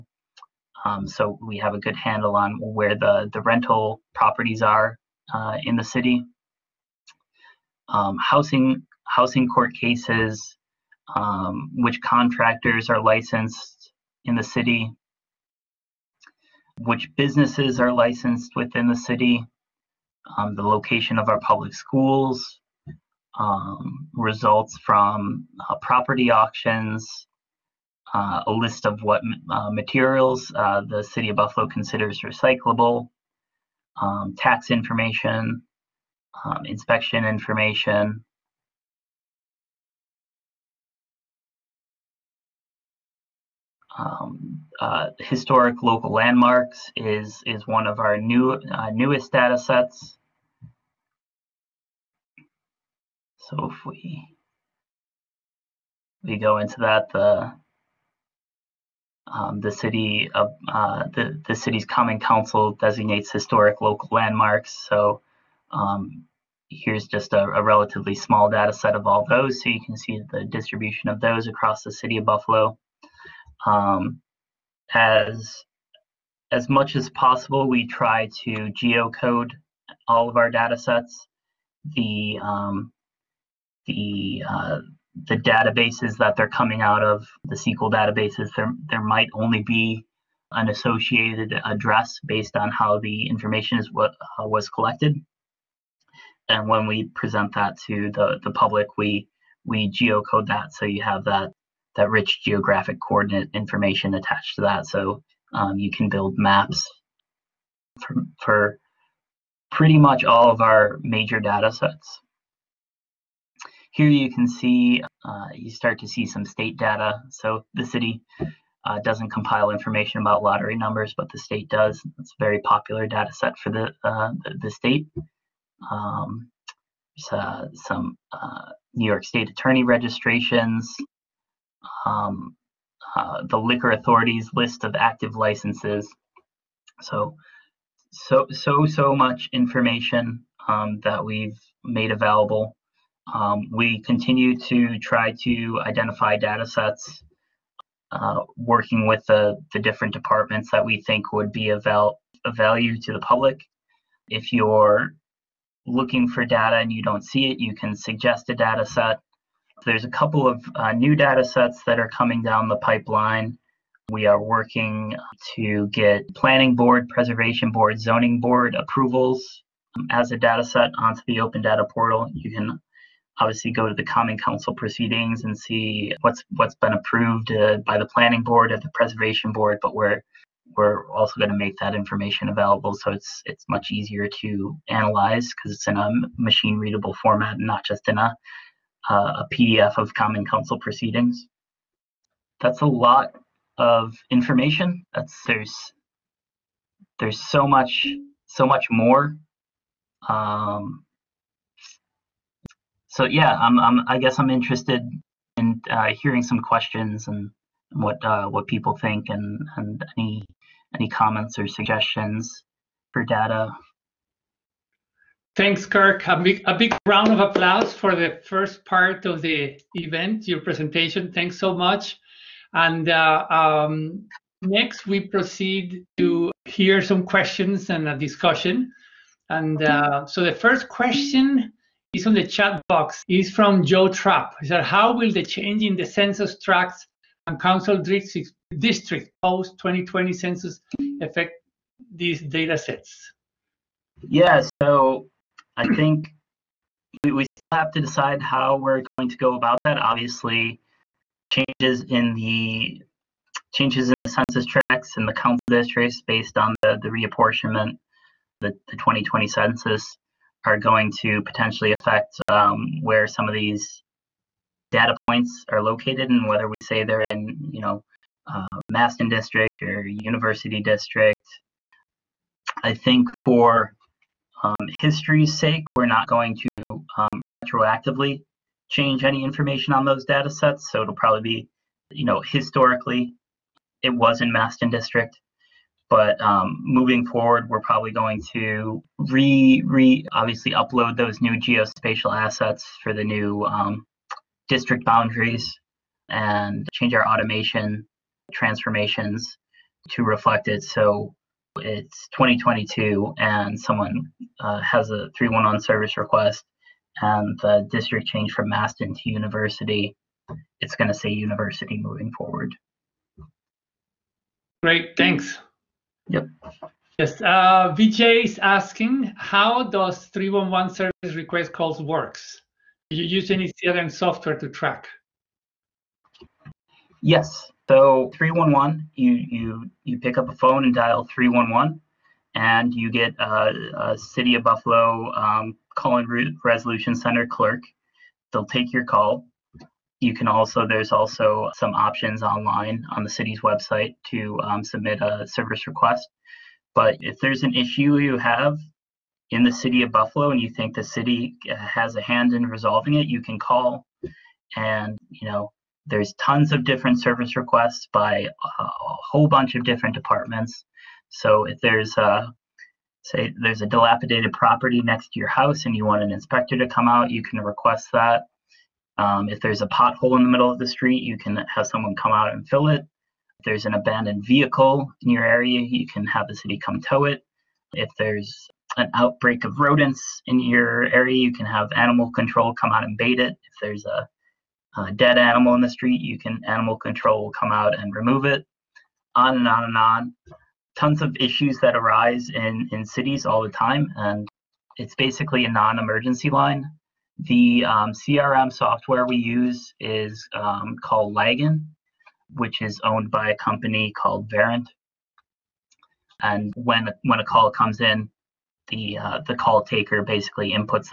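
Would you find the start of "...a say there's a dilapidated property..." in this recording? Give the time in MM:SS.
06:02.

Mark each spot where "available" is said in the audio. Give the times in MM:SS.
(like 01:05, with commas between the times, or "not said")
02:22, 03:02.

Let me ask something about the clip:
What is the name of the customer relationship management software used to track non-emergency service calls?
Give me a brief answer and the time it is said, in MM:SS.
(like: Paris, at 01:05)
Lagan, at 06:41.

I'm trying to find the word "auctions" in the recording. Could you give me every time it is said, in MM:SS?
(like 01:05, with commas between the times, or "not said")
00:26.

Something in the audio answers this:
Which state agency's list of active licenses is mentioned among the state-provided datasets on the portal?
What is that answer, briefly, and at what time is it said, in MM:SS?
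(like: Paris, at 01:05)
Liquor Authority, at 02:13.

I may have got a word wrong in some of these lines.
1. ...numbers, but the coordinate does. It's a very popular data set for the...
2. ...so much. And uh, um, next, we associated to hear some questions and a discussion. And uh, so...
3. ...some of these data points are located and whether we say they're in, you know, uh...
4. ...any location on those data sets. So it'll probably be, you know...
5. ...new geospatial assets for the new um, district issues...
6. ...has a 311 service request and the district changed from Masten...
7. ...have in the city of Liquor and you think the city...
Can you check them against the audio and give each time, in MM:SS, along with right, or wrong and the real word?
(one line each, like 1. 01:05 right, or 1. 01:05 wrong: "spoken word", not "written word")
1. 02:00 wrong: "state", not "coordinate"
2. 03:41 wrong: "proceed", not "associated"
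3. 04:23 right
4. 04:39 wrong: "information", not "location"
5. 04:51 wrong: "boundaries", not "issues"
6. 05:04 right
7. 05:48 wrong: "Buffalo", not "Liquor".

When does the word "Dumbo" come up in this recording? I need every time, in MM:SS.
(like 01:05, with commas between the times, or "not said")
not said.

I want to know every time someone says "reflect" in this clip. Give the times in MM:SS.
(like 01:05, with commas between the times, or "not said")
05:00.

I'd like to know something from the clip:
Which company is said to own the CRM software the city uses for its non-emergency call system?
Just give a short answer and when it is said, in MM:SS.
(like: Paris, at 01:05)
Verint, at 06:44.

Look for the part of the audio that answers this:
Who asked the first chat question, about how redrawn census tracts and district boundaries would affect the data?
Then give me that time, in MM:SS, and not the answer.
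03:53.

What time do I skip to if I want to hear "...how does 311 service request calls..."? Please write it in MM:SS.
05:19.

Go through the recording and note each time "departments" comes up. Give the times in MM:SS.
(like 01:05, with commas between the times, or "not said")
02:30, 06:00.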